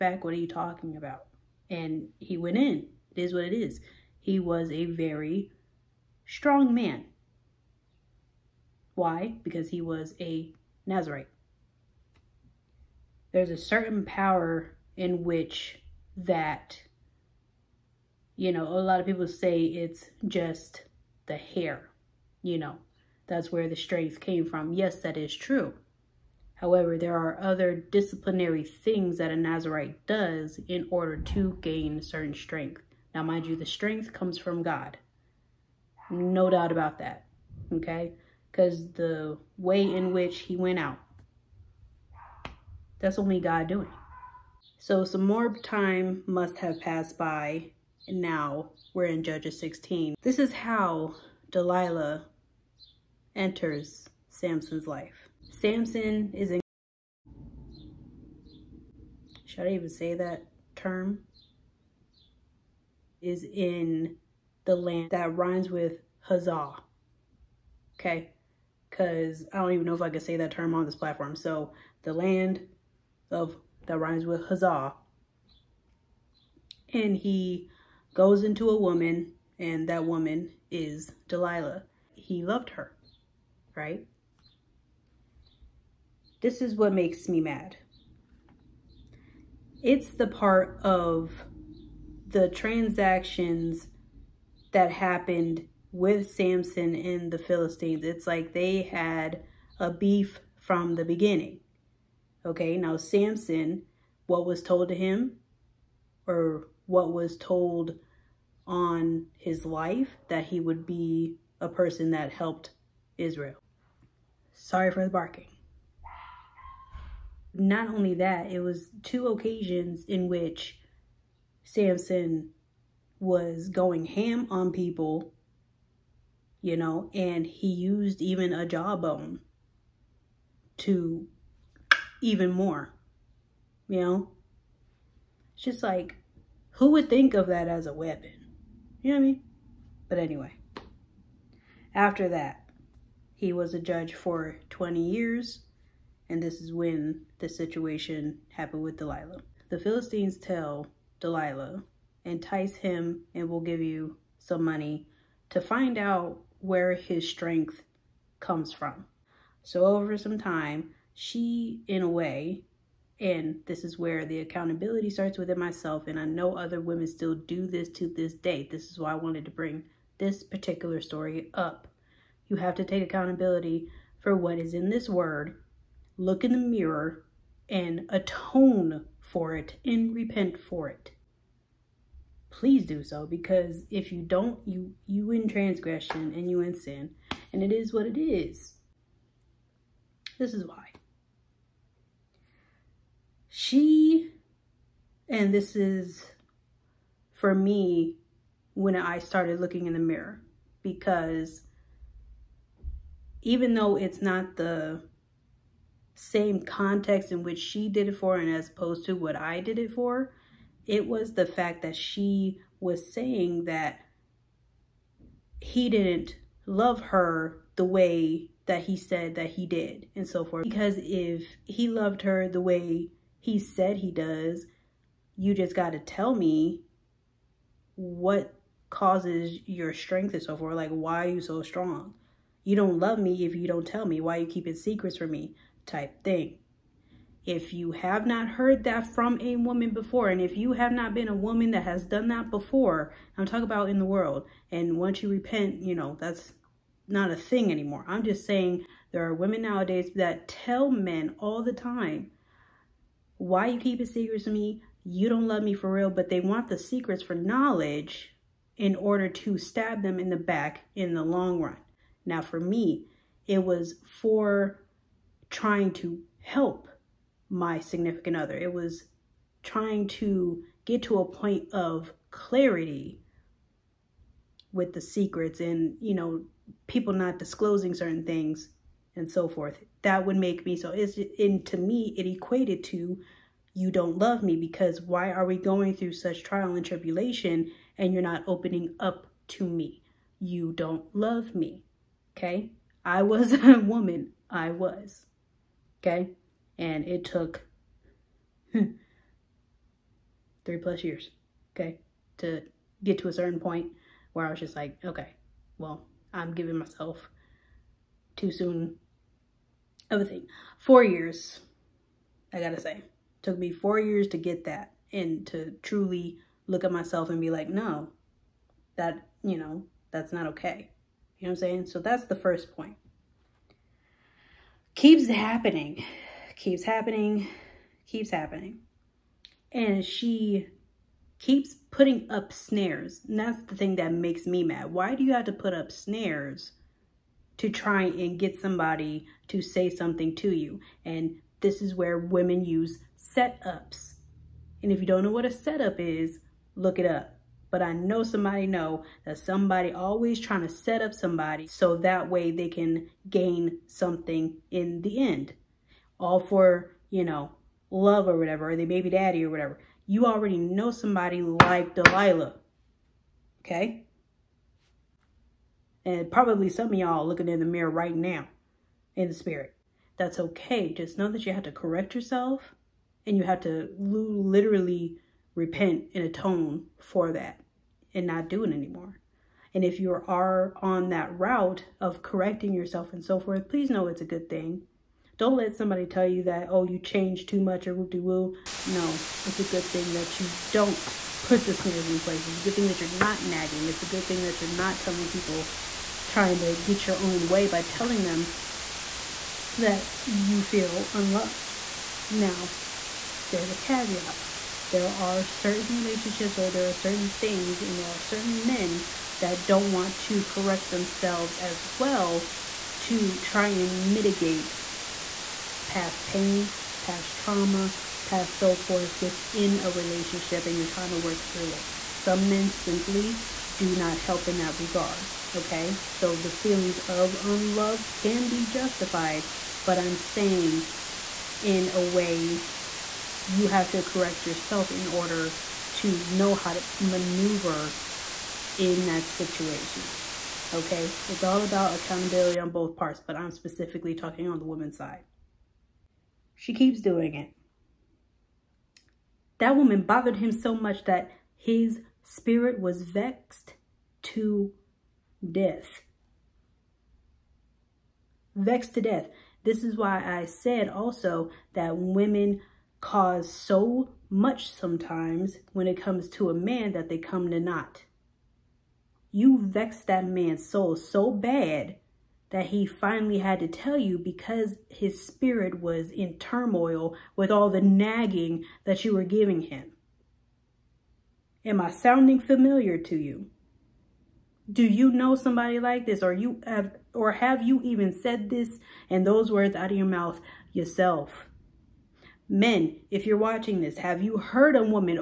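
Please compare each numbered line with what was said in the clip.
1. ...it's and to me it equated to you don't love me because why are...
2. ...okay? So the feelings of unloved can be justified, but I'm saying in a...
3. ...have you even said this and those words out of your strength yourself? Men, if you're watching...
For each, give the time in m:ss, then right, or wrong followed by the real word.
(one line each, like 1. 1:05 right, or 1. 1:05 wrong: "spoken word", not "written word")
1. 4:40 right
2. 7:05 right
3. 8:07 wrong: "mouth", not "strength".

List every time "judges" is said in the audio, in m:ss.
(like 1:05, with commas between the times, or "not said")
0:49, 2:23.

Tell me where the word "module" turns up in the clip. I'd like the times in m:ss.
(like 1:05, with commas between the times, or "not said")
not said.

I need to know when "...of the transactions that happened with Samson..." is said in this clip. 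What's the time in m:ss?
1:30.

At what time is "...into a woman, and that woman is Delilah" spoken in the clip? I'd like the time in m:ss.
1:18.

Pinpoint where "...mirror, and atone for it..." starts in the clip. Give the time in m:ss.
2:56.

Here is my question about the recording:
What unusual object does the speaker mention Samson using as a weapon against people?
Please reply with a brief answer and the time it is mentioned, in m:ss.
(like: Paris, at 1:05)
A jawbone, at 2:08.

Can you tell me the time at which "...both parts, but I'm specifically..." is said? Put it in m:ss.
7:22.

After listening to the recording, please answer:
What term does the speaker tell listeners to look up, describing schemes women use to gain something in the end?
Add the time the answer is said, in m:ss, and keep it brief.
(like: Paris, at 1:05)
Setup, at 5:43.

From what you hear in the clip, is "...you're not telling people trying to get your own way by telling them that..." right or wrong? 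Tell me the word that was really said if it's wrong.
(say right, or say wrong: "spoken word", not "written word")
right.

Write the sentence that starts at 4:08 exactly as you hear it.
I'm just saying there are women nowadays that tell men all the time why you keep it secrets from me?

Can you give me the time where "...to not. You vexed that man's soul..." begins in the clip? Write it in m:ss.
7:47.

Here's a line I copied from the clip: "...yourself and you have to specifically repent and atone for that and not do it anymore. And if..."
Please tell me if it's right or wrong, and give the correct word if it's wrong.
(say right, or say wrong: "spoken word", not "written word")
wrong: "literally", not "specifically".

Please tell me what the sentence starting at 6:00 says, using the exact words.
You already know somebody like Delilah, okay?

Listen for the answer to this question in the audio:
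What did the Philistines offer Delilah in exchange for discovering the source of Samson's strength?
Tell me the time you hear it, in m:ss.
2:34.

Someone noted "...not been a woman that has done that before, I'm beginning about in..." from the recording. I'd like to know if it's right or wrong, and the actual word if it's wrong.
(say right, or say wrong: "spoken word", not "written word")
wrong: "talking", not "beginning".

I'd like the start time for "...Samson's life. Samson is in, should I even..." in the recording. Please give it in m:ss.
0:54.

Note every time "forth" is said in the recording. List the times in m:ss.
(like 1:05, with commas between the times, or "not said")
3:40, 3:50, 4:39, 6:23, 6:58.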